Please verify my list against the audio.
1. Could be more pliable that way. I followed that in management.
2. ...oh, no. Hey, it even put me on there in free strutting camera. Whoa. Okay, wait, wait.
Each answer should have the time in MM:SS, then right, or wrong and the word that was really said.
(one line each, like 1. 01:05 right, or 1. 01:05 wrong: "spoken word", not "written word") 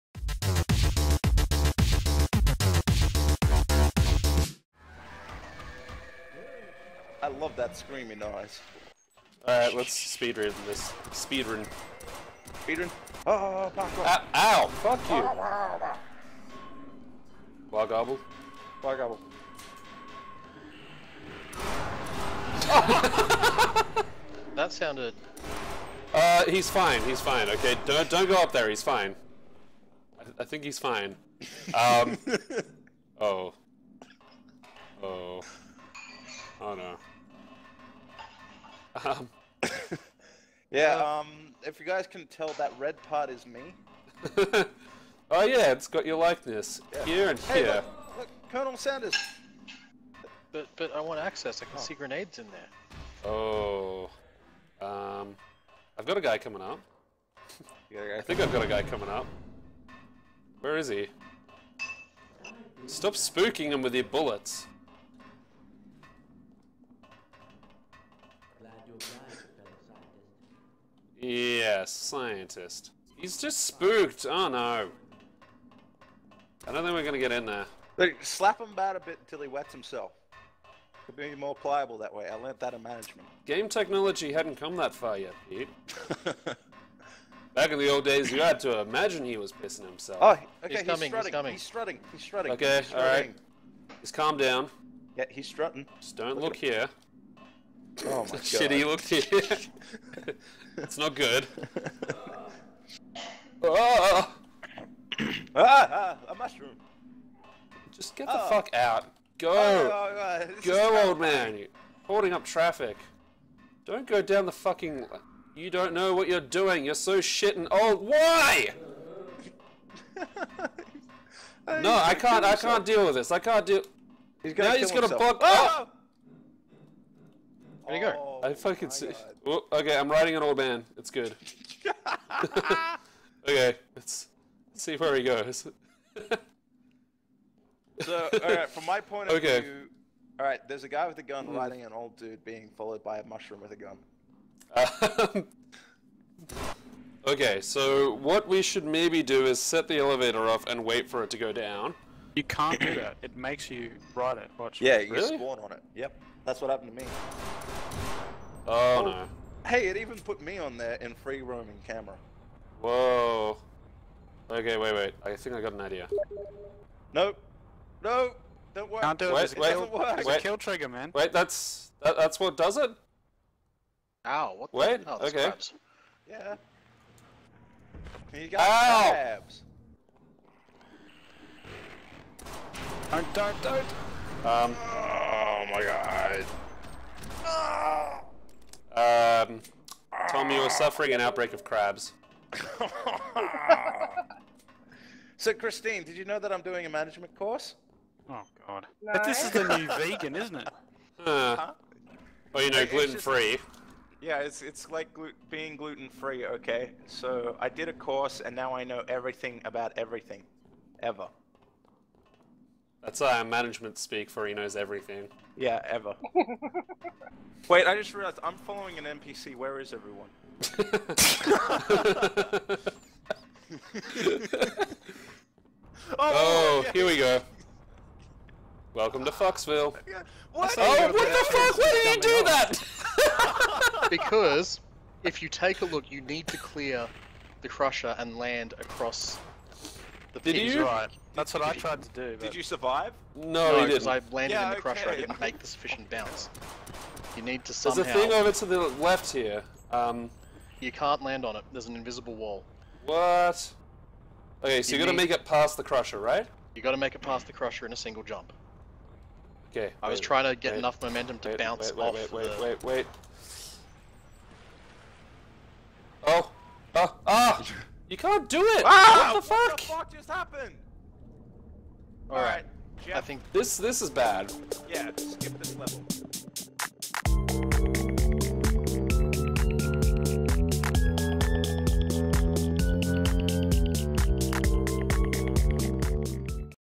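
1. 01:21 wrong: "learned", not "followed"
2. 02:38 wrong: "roaming", not "strutting".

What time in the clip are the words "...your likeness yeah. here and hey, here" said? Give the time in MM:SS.
00:46.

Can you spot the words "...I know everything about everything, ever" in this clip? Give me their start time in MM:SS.
03:28.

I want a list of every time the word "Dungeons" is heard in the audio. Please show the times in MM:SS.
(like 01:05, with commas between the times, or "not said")
not said.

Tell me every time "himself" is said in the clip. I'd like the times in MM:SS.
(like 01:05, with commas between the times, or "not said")
01:19, 01:29, 02:05.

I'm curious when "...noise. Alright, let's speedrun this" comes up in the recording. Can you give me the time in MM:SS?
00:08.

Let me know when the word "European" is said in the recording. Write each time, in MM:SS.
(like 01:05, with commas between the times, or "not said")
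not said.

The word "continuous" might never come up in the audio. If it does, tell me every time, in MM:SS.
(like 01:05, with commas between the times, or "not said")
not said.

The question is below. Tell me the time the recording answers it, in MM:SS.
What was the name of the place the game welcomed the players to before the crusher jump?
03:49.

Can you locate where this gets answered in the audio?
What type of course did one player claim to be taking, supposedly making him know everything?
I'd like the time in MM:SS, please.
03:16.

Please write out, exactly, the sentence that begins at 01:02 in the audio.
Stop spooking him with your bullets.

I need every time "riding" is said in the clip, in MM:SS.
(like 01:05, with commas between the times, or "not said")
02:10, 02:21.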